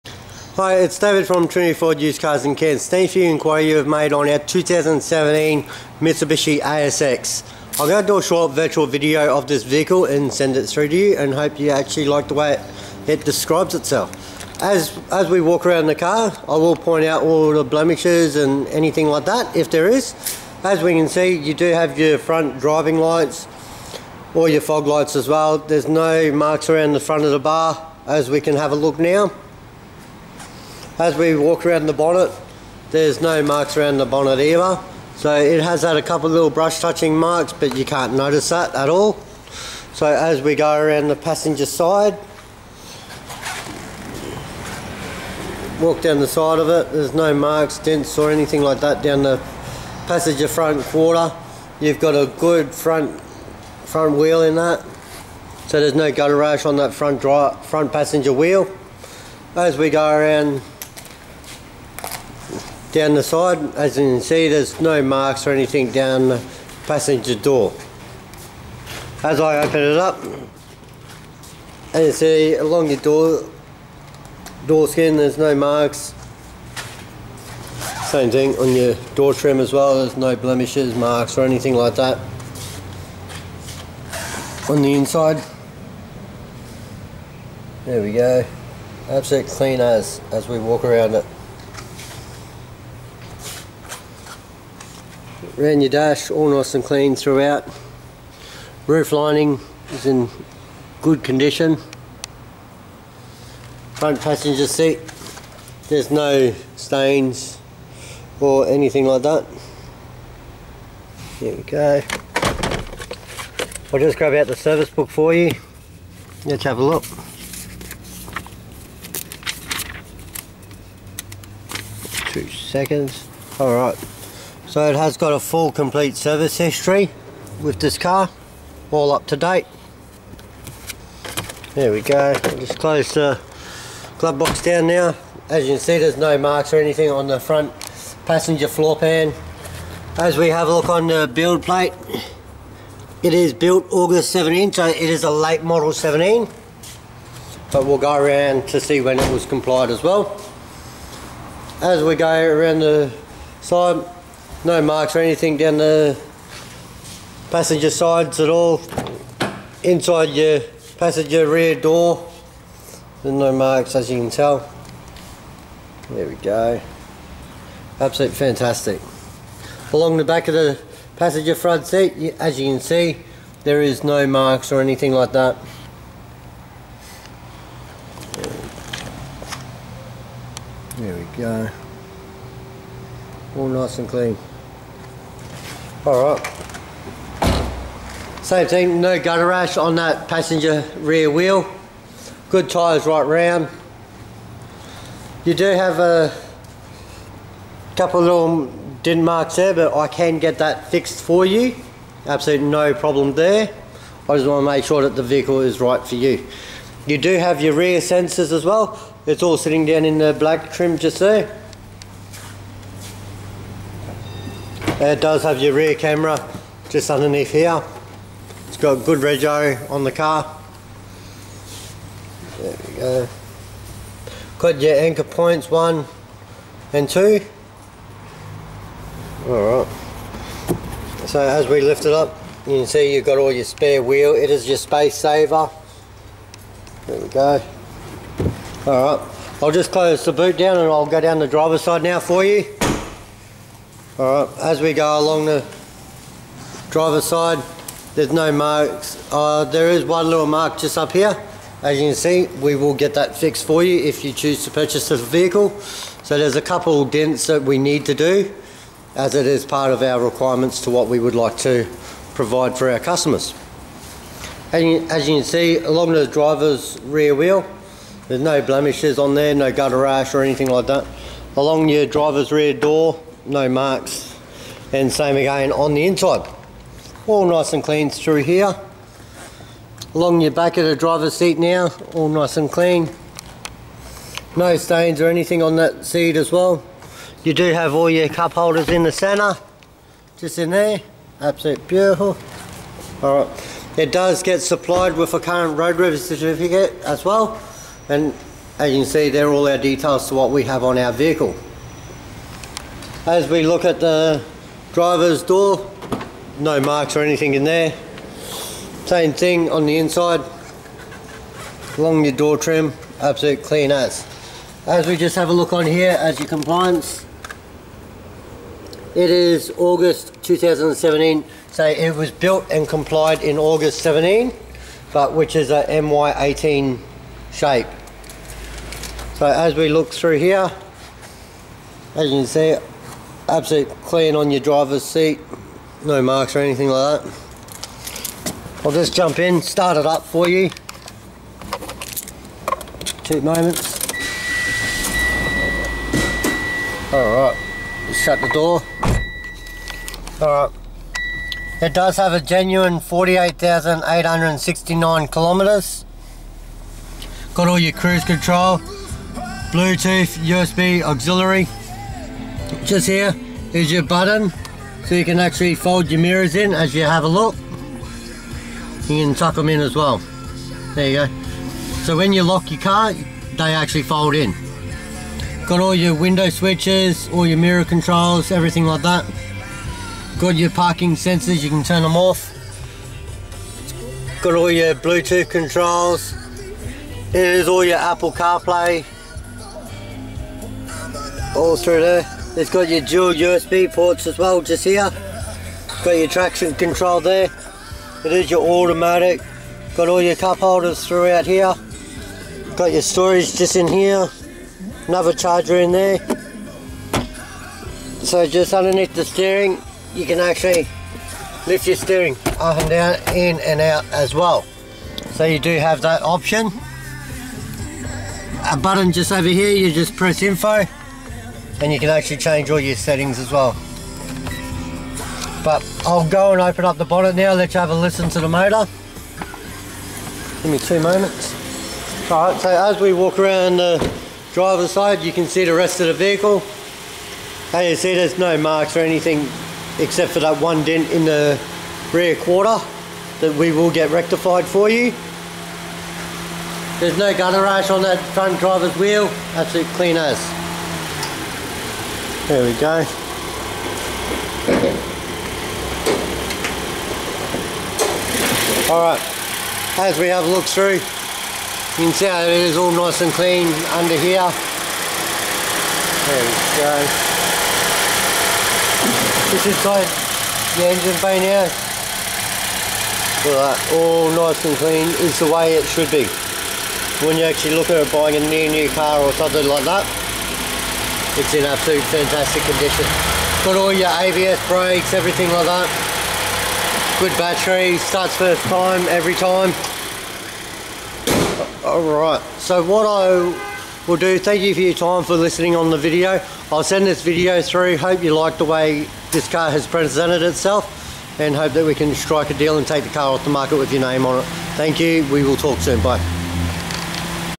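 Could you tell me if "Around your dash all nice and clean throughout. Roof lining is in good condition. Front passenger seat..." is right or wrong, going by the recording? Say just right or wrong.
right.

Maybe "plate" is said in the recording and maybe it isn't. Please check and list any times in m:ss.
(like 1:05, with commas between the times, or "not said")
2:21.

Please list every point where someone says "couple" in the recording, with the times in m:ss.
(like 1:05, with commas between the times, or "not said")
0:36, 3:17, 4:16.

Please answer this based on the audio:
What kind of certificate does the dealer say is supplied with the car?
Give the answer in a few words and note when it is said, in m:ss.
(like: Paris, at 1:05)
Roadworthy certificate, at 4:55.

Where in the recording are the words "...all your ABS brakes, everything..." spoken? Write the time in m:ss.
8:03.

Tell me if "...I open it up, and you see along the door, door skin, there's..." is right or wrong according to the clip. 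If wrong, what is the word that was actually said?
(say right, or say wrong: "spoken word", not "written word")
right.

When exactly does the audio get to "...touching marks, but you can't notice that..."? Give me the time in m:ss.
0:36.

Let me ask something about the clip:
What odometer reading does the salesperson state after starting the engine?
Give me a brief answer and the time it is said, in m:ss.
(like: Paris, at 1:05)
48,869 kilometers, at 5:53.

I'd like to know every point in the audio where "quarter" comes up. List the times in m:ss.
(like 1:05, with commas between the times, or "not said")
0:50, 7:22.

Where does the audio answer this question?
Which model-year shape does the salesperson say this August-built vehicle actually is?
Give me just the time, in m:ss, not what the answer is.
5:25.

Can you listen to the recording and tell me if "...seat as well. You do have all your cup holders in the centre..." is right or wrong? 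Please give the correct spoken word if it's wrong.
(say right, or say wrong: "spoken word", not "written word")
right.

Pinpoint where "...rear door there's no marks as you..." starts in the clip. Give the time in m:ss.
2:41.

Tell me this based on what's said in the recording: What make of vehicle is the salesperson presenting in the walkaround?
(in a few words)
Mitsubishi.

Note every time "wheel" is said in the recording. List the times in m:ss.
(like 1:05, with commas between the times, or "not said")
0:54, 0:58, 3:11, 3:54, 4:27, 7:28.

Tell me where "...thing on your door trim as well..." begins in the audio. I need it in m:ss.
1:18.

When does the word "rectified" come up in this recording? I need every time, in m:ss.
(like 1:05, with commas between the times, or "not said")
7:24.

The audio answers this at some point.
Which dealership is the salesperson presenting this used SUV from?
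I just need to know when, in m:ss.
0:01.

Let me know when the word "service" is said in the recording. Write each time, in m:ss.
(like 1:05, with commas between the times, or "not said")
1:54, 2:06.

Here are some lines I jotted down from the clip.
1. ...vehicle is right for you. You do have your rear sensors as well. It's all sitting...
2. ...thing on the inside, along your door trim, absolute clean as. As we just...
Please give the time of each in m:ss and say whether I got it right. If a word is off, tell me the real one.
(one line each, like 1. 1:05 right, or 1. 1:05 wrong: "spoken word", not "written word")
1. 3:25 right
2. 5:09 right.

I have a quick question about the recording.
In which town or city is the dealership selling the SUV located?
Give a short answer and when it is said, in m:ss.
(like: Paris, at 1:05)
Cairns, at 0:02.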